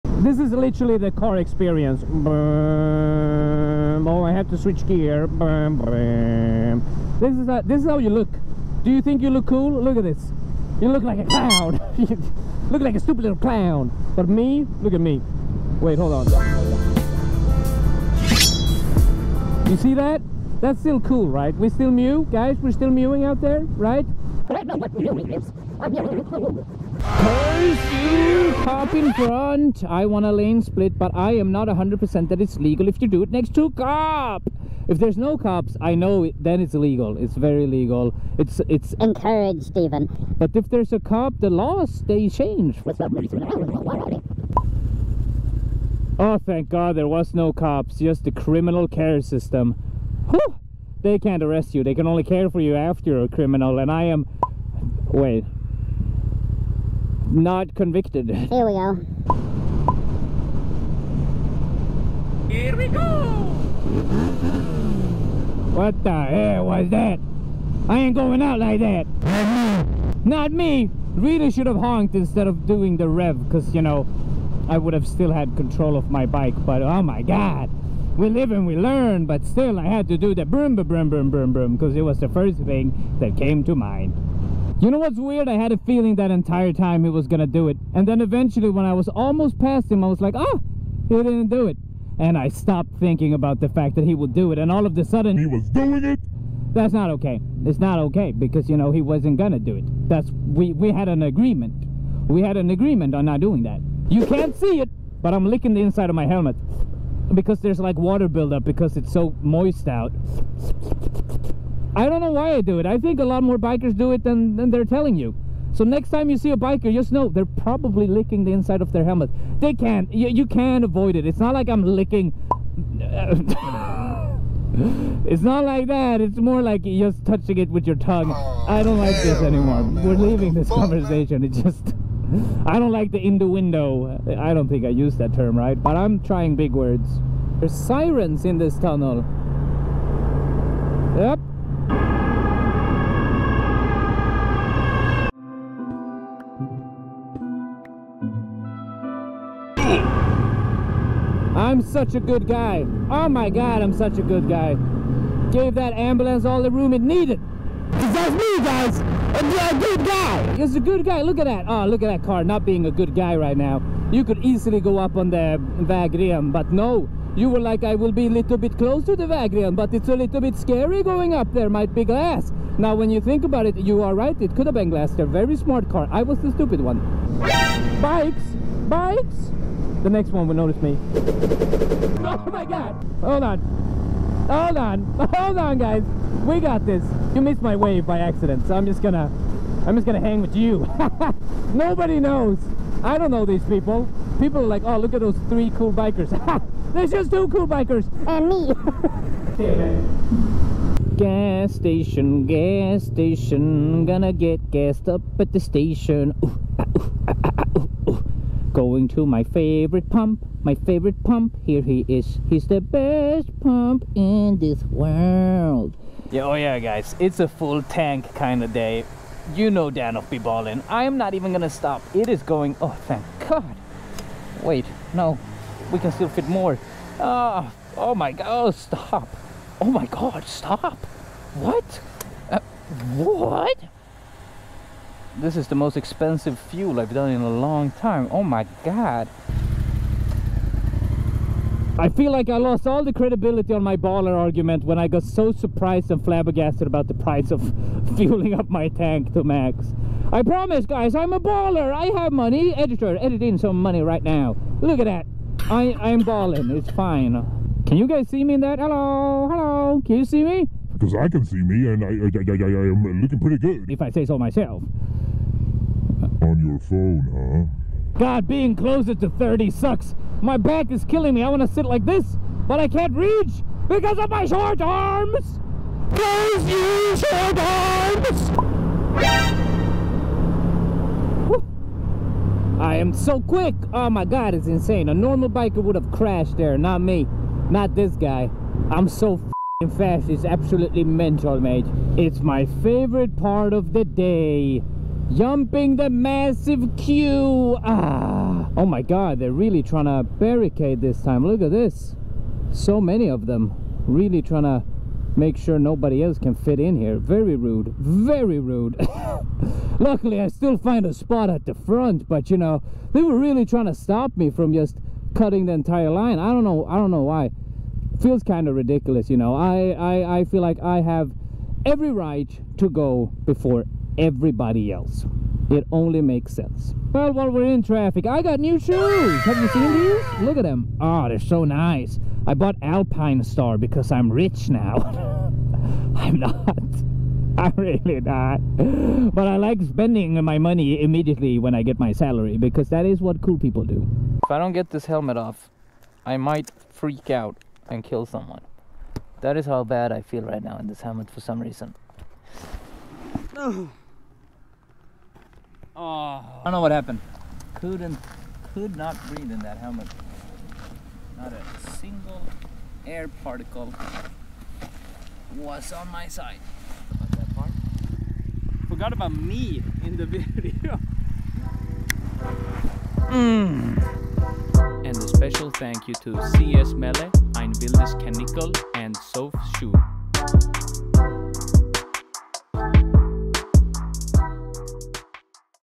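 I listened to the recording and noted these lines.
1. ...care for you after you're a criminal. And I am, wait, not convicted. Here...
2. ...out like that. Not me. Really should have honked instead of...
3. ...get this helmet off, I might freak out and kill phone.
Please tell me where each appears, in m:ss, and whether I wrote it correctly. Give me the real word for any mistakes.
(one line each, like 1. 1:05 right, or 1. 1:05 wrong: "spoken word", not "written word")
1. 0:52 right
2. 1:08 right
3. 5:44 wrong: "someone", not "phone".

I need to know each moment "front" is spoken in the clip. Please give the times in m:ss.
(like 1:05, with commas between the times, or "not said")
0:29, 5:11.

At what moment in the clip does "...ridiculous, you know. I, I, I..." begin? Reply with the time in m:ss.
5:18.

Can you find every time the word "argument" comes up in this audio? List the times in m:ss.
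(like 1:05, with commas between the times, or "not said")
4:04.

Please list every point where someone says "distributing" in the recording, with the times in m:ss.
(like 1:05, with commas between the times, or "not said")
not said.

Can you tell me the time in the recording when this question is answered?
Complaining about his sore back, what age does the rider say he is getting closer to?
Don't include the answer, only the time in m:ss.
4:29.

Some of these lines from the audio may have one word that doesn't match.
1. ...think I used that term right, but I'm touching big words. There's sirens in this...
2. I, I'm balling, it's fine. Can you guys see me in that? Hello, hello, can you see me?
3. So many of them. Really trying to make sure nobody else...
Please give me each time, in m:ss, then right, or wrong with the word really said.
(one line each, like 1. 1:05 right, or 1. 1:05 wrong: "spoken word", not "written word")
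1. 2:14 wrong: "trying", not "touching"
2. 4:15 right
3. 5:02 right.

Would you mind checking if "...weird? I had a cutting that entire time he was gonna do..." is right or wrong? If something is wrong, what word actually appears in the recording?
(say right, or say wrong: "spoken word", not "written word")
wrong: "feeling", not "cutting".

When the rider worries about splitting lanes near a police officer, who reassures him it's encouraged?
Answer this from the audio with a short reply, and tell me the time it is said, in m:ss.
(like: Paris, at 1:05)
Stephen, at 0:39.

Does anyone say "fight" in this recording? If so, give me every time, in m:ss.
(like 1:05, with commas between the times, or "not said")
not said.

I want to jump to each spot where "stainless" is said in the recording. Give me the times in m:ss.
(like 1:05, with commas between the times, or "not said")
not said.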